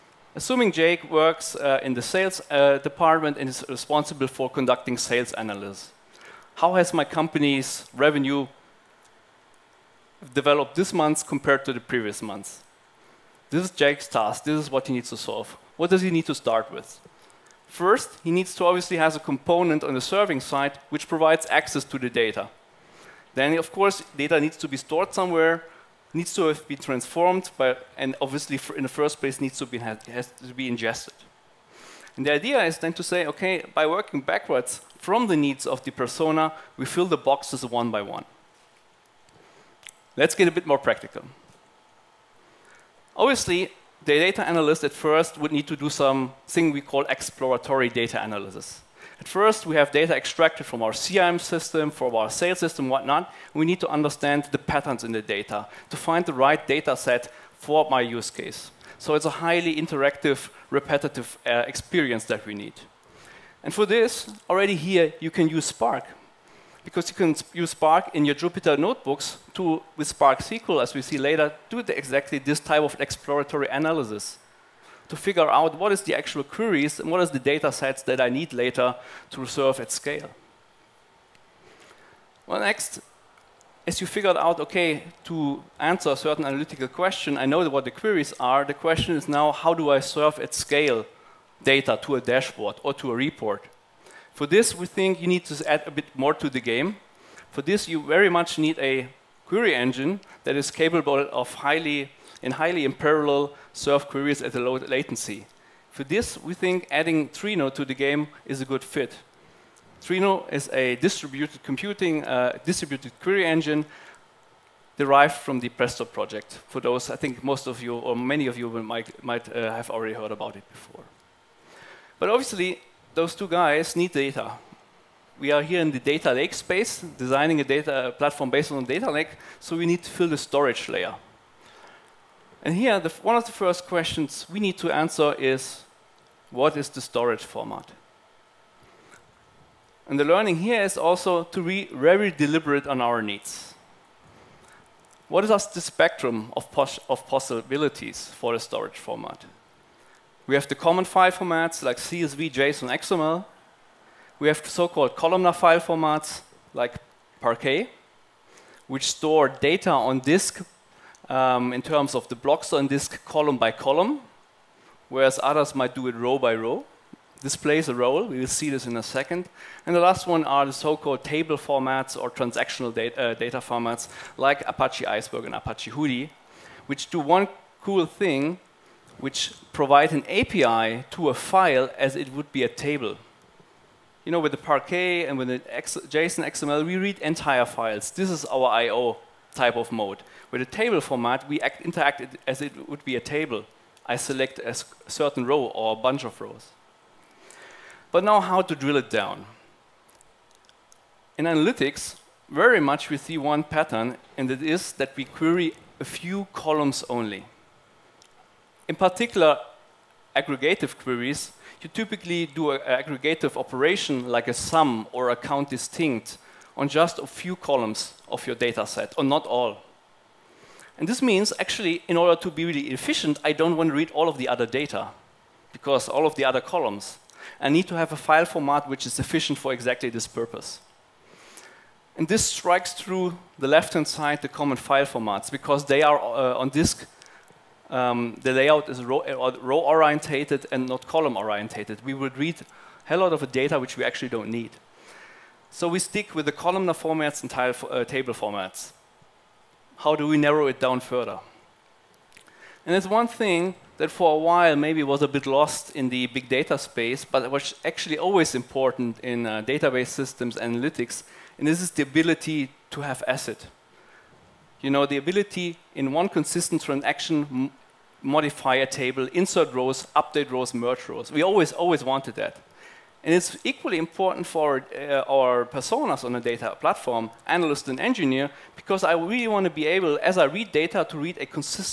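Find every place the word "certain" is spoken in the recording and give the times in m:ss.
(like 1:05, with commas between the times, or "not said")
1:26, 3:15.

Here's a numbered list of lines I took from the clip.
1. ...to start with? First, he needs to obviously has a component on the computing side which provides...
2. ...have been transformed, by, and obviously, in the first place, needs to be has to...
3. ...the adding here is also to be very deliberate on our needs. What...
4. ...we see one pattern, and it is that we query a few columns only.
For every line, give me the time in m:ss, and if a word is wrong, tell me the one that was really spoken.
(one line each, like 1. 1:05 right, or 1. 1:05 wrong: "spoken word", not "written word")
1. 0:16 wrong: "serving", not "computing"
2. 0:26 right
3. 2:20 wrong: "learning", not "adding"
4. 3:23 right.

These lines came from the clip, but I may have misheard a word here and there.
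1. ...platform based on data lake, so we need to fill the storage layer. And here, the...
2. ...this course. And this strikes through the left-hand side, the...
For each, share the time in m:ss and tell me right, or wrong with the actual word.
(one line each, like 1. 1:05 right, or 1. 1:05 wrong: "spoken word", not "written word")
1. 2:08 right
2. 3:50 wrong: "purpose", not "course".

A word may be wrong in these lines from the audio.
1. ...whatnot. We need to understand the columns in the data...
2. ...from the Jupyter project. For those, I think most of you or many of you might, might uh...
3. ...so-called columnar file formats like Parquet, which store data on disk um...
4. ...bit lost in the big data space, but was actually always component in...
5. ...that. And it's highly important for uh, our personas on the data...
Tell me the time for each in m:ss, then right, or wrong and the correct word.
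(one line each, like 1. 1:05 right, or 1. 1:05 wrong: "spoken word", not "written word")
1. 0:52 wrong: "patterns", not "columns"
2. 1:55 wrong: "Presto", not "Jupyter"
3. 2:34 right
4. 4:15 wrong: "important", not "component"
5. 4:32 wrong: "equally", not "highly".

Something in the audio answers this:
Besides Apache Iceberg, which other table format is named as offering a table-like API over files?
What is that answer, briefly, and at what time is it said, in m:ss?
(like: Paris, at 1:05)
Apache Hudi, at 2:55.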